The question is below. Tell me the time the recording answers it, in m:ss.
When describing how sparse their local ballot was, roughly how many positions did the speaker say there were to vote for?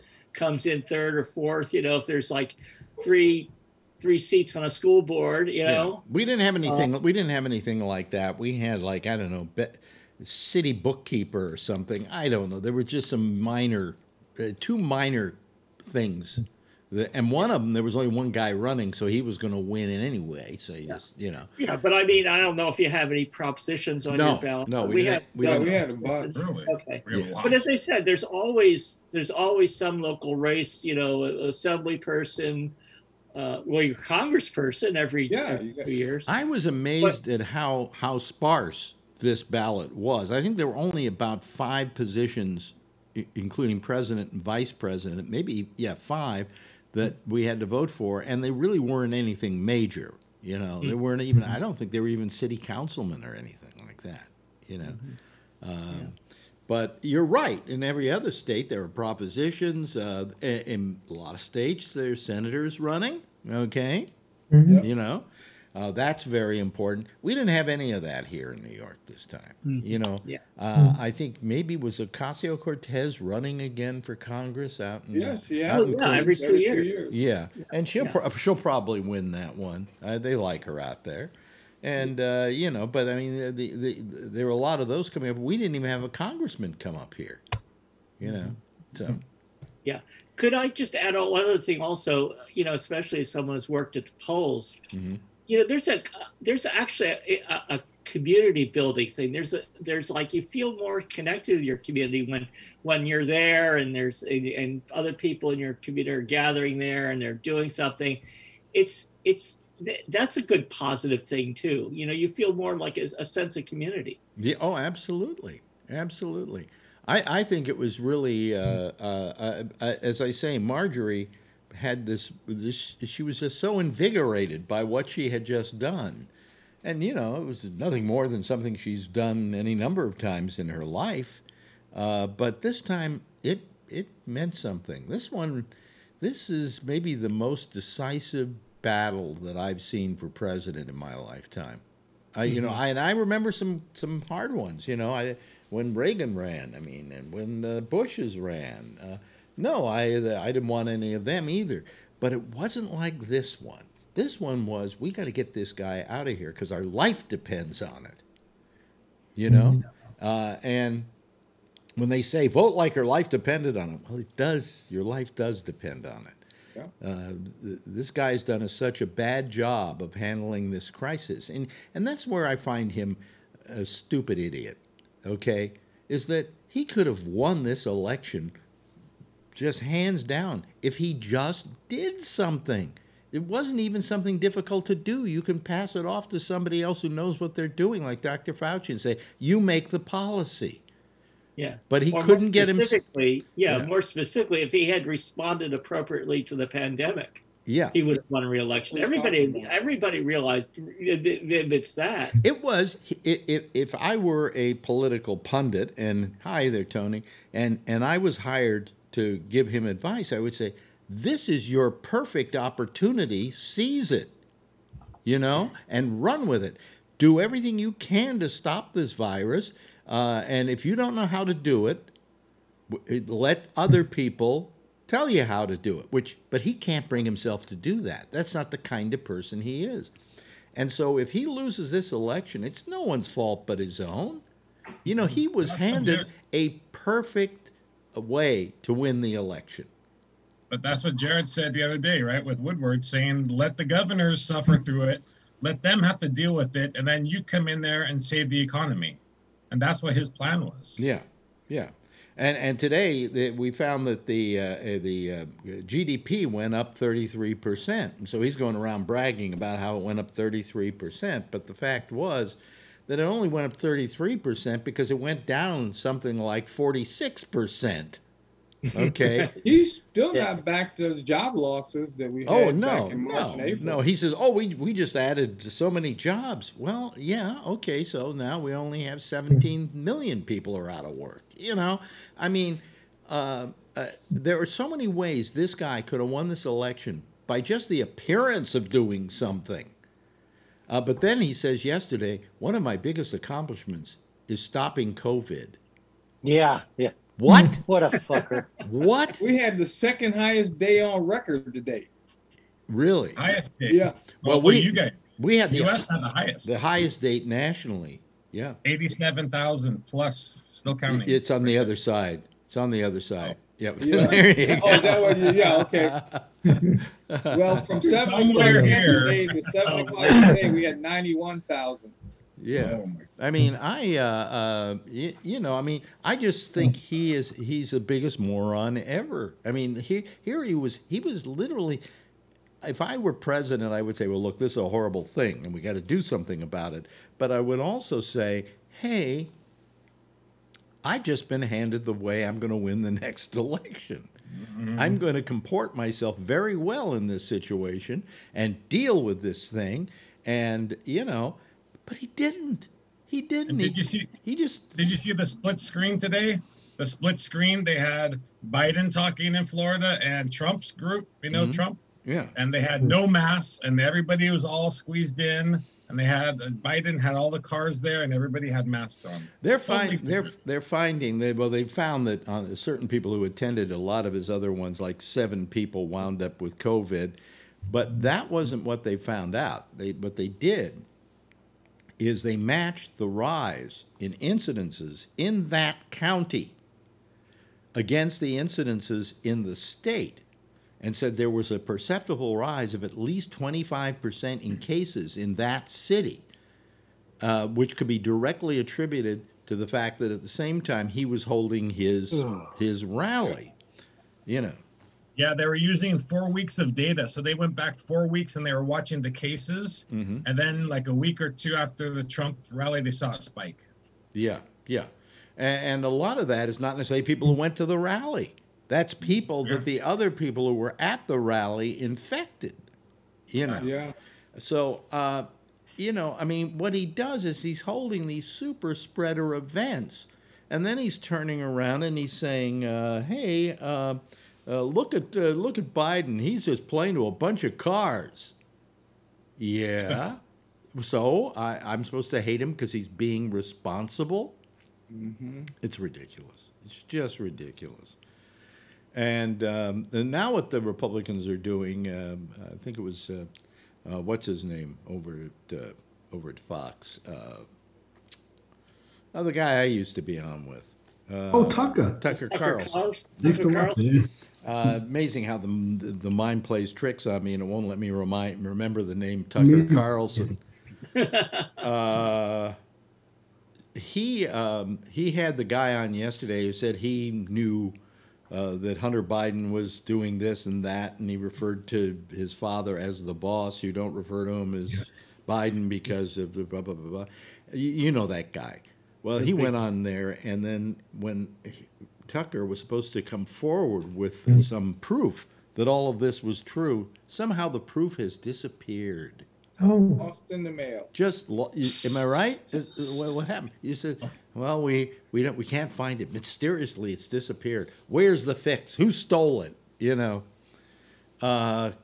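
0:40.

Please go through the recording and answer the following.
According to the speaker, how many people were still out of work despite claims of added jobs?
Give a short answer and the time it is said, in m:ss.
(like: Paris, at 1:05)
17 million, at 4:39.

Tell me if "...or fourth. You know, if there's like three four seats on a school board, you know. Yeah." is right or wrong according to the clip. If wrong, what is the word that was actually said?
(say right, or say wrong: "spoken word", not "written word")
wrong: "three", not "four".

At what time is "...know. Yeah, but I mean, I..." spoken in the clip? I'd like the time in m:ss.
0:21.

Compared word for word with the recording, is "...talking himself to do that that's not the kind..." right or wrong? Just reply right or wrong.
wrong.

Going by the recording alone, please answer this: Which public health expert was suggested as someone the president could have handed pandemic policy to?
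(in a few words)
Dr. Fauci.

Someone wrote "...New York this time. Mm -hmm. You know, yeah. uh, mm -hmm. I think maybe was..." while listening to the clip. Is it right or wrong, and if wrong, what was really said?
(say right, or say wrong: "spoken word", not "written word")
right.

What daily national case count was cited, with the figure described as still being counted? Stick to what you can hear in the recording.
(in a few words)
87,000.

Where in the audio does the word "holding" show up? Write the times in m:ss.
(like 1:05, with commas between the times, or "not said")
6:41, 7:07.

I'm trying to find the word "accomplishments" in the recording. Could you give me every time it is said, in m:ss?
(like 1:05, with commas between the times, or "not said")
4:53.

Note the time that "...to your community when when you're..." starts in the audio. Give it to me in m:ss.
1:41.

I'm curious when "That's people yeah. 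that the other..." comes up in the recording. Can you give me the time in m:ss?
6:58.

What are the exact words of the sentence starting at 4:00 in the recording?
But that's what Jared said the other day, right?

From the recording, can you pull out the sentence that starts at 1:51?
You know, you feel more like a, a sense of community.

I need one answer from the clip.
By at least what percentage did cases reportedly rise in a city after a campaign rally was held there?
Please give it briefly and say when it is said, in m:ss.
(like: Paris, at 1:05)
25%, at 6:33.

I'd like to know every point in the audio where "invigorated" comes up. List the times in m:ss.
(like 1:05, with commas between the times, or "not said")
2:03.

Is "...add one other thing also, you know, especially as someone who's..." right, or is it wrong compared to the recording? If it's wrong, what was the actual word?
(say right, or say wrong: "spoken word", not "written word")
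right.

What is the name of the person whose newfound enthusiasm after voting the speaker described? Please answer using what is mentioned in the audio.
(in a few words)
Marjorie.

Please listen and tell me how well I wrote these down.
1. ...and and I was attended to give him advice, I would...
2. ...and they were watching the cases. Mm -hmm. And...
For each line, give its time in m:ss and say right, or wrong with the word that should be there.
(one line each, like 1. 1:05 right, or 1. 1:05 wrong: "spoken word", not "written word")
1. 3:27 wrong: "hired", not "attended"
2. 6:48 right.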